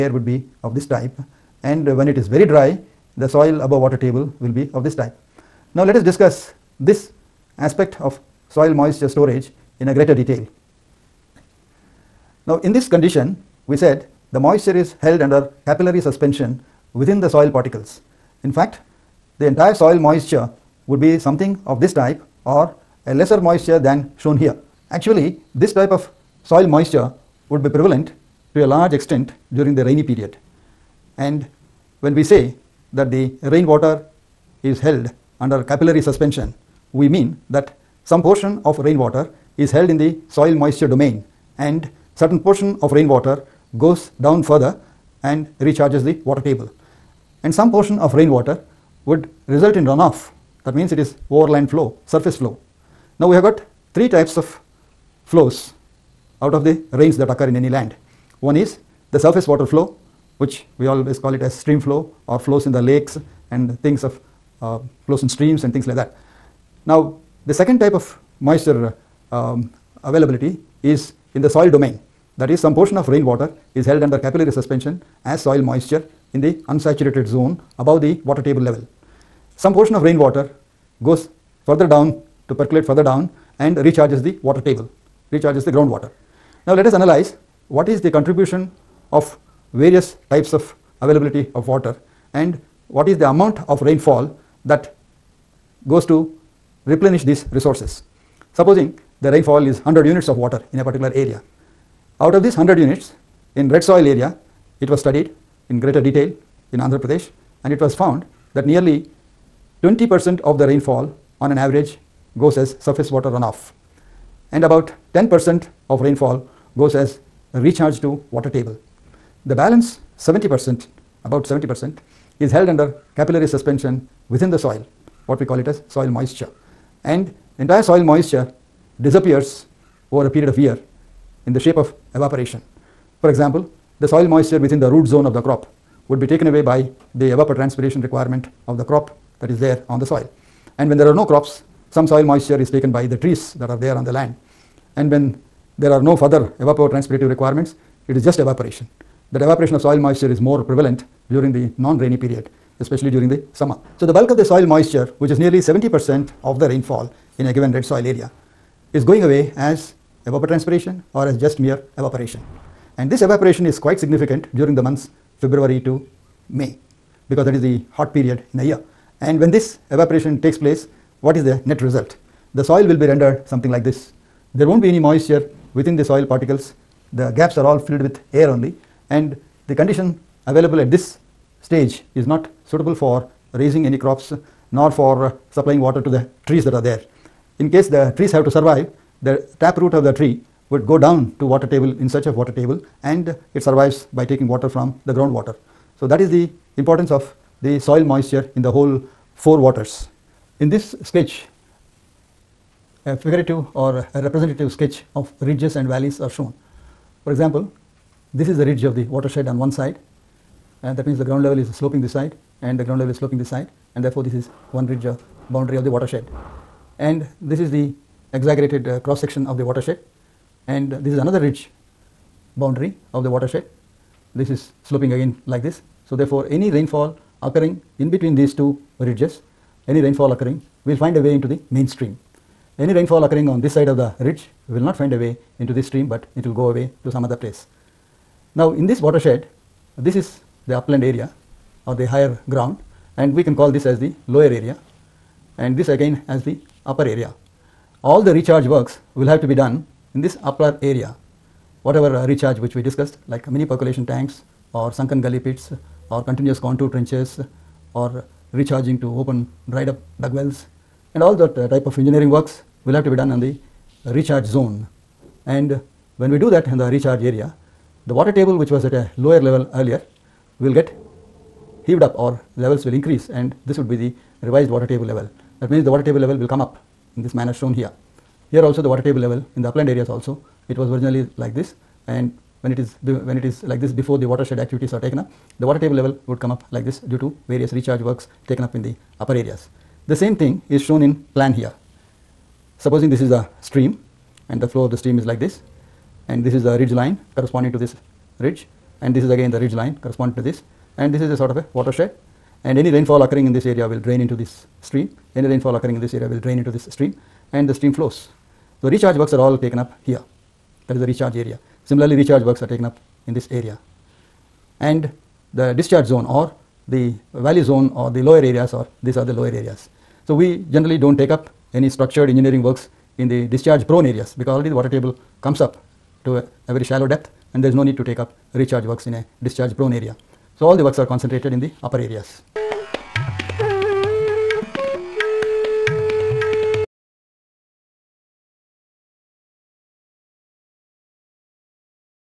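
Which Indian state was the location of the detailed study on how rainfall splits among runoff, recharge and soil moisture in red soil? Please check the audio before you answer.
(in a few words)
Andhra Pradesh.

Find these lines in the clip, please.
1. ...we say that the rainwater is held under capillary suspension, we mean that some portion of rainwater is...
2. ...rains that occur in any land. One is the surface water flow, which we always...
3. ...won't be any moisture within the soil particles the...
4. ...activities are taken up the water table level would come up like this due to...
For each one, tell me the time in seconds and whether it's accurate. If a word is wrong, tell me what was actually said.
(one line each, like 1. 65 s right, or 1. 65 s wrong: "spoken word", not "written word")
1. 32 s right
2. 56 s right
3. 174 s right
4. 284 s right.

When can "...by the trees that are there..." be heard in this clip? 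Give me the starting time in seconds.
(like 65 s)
142 s.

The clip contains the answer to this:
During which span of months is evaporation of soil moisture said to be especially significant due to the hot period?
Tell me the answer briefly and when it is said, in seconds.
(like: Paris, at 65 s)
February to May, at 165 s.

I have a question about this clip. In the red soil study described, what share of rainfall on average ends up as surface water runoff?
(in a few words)
20%.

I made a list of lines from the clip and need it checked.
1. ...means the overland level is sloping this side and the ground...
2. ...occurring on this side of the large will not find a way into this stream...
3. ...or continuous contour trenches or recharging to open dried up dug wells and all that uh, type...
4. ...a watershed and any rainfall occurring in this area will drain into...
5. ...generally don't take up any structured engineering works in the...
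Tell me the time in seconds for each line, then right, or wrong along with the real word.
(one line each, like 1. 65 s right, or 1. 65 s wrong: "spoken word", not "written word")
1. 211 s wrong: "ground", not "overland"
2. 233 s wrong: "ridge", not "large"
3. 256 s right
4. 301 s right
5. 320 s right.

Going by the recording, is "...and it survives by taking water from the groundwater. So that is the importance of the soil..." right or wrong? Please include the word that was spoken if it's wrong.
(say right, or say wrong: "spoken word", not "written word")
right.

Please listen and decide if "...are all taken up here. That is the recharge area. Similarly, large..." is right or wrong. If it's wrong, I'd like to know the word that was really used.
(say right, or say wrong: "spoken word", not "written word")
wrong: "recharge", not "large".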